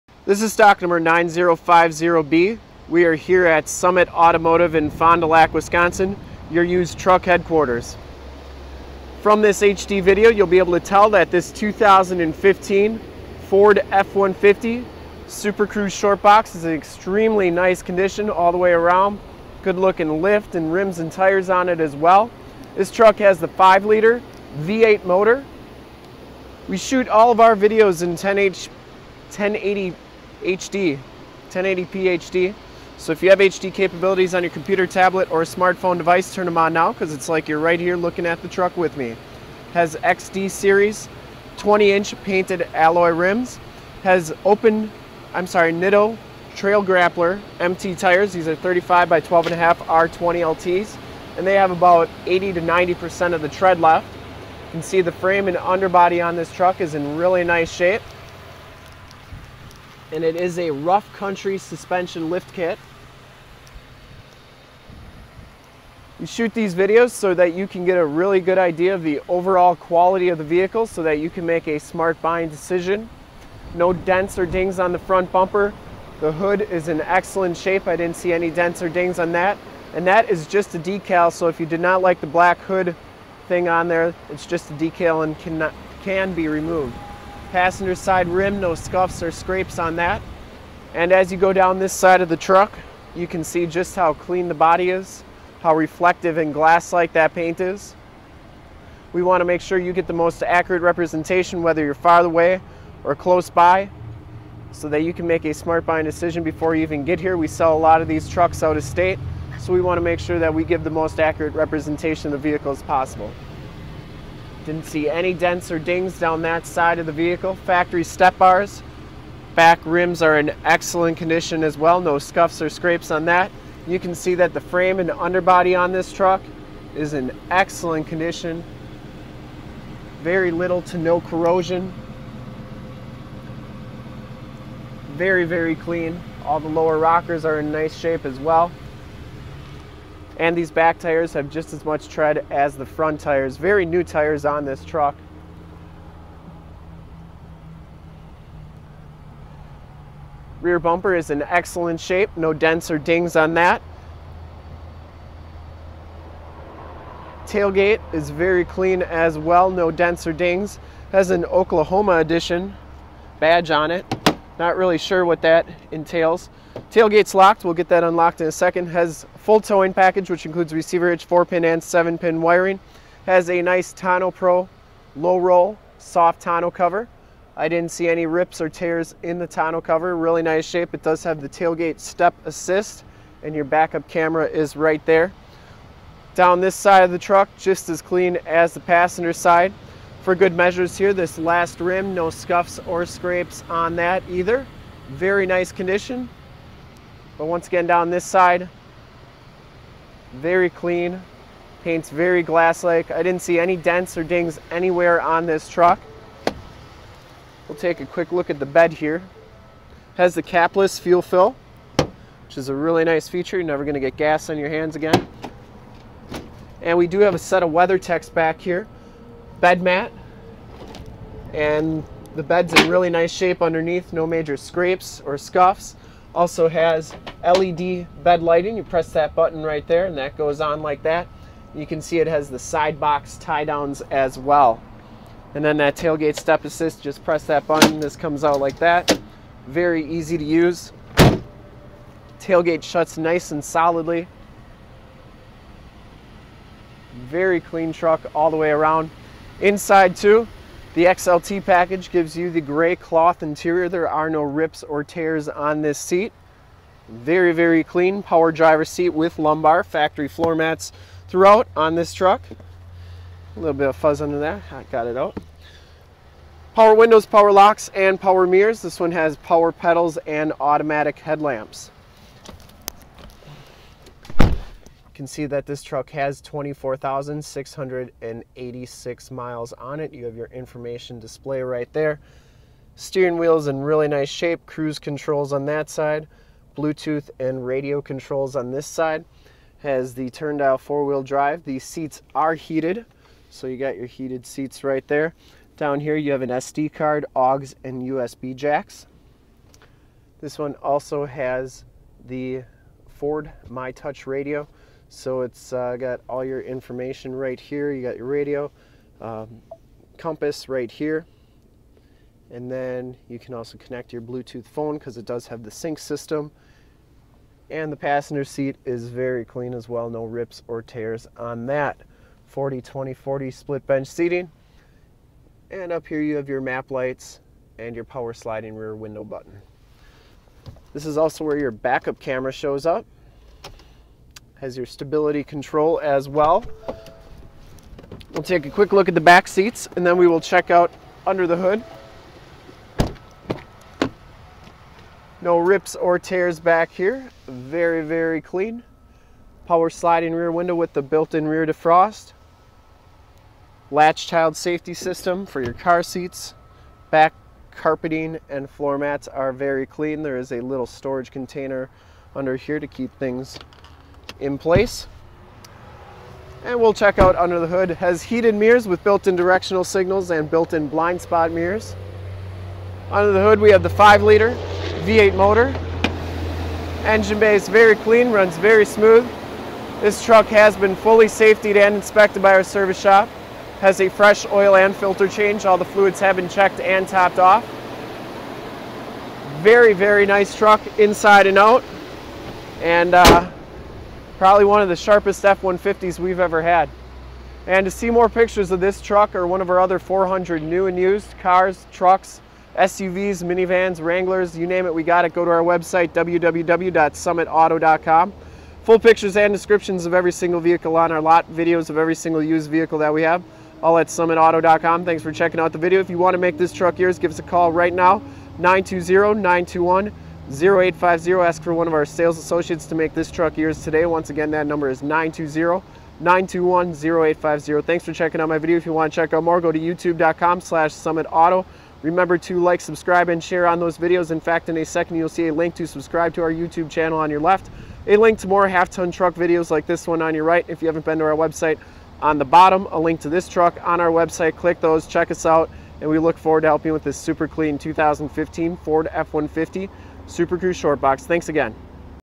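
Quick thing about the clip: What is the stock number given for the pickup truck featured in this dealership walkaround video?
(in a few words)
9050B.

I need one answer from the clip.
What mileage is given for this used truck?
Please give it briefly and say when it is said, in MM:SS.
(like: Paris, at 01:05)
24,686, at 04:36.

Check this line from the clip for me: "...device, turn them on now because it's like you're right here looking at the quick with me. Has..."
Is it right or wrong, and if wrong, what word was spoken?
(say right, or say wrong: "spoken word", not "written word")
wrong: "truck", not "quick".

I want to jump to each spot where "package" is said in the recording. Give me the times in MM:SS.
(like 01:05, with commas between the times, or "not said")
02:49, 04:11.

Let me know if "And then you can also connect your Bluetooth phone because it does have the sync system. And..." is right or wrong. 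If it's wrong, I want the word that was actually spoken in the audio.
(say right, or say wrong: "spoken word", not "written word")
right.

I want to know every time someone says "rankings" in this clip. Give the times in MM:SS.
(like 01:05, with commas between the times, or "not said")
not said.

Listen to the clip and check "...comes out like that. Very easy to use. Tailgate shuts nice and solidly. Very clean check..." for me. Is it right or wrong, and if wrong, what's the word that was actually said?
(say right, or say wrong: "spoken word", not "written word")
wrong: "truck", not "check".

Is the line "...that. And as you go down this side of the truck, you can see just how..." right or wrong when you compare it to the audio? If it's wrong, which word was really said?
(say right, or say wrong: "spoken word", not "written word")
right.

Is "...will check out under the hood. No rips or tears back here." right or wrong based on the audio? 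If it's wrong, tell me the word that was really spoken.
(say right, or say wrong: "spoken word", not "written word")
right.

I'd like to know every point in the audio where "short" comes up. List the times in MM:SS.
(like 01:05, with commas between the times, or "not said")
00:15, 07:30.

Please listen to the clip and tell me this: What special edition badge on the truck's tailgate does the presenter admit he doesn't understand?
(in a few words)
Oklahoma edition.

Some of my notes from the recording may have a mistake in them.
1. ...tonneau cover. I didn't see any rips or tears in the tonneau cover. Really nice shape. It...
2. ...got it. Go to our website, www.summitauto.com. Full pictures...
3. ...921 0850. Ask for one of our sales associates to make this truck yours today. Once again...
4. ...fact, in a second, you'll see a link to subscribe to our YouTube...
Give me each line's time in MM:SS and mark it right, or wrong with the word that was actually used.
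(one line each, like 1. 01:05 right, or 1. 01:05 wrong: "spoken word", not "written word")
1. 02:56 right
2. 06:45 right
3. 06:59 right
4. 07:14 right.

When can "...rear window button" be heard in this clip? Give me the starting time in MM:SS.
05:28.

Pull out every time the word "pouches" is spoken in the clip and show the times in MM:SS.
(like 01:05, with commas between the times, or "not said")
not said.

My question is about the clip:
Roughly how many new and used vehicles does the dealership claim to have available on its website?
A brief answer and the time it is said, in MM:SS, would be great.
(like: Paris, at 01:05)
400, at 06:39.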